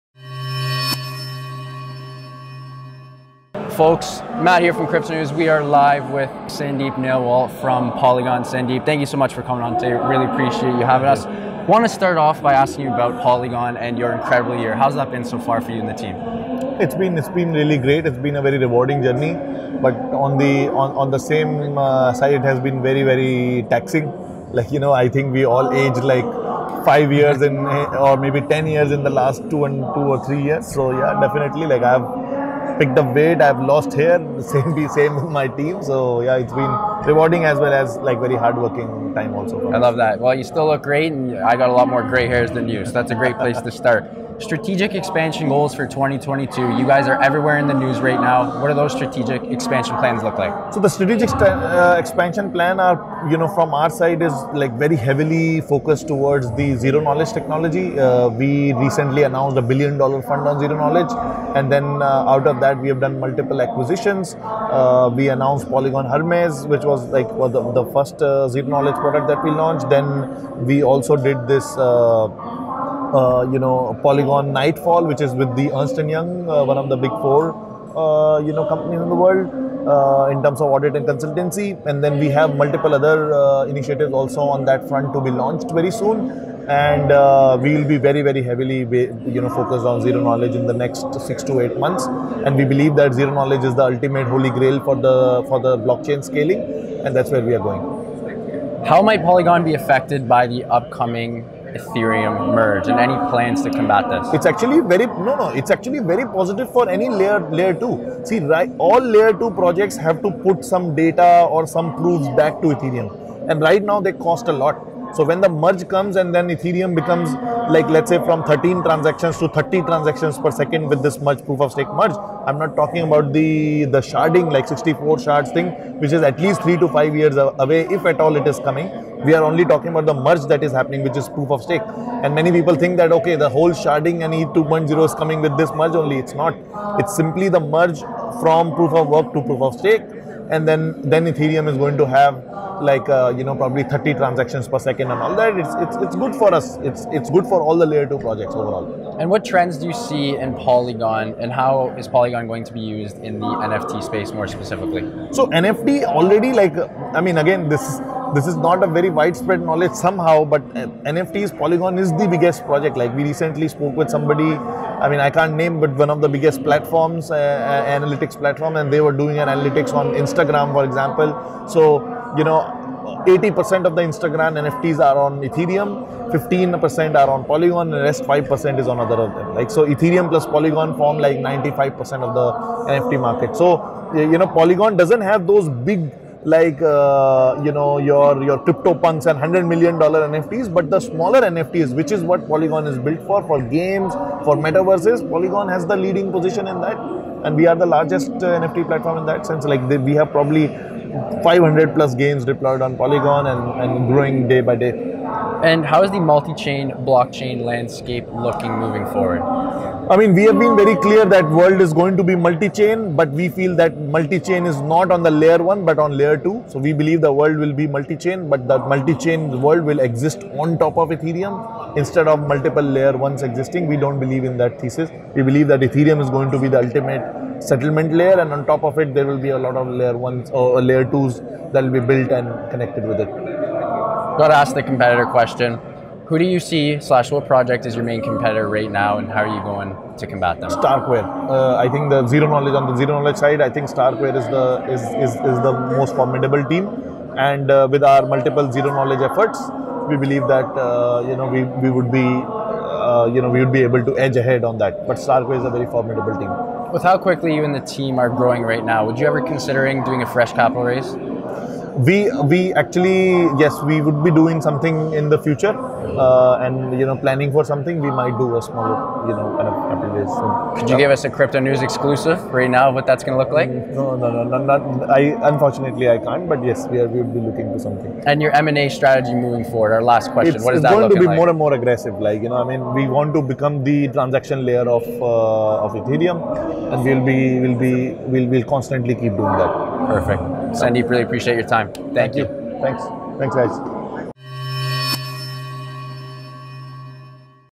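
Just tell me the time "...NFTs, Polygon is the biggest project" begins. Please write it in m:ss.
2:41.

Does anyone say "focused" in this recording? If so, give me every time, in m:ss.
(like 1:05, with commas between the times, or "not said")
0:55, 1:29.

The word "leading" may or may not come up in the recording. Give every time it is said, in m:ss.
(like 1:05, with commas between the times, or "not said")
3:15.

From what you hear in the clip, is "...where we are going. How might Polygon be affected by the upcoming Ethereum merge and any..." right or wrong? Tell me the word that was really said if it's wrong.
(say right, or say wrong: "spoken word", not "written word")
right.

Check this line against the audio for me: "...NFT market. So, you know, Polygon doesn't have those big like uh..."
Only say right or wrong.
right.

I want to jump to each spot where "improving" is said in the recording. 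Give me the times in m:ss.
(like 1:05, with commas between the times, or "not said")
not said.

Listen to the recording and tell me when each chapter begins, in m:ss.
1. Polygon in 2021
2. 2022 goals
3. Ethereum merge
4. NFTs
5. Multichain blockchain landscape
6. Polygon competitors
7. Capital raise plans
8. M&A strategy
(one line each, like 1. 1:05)
1. 0:11
2. 0:44
3. 1:38
4. 2:29
5. 3:25
6. 3:53
7. 4:16
8. 4:38.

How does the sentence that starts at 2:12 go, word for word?
And many people think that, okay, the whole sharding and E2.0 is coming with this merge only.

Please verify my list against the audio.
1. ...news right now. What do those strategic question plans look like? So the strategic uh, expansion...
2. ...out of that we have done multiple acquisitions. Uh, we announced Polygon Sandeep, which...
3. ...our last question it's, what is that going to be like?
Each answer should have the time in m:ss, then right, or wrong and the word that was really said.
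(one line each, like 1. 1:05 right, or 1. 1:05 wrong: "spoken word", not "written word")
1. 0:47 wrong: "expansion", not "question"
2. 1:02 wrong: "Hermez", not "Sandeep"
3. 4:39 right.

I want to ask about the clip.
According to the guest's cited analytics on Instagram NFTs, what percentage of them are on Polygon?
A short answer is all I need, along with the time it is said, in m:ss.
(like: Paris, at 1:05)
15%, at 2:56.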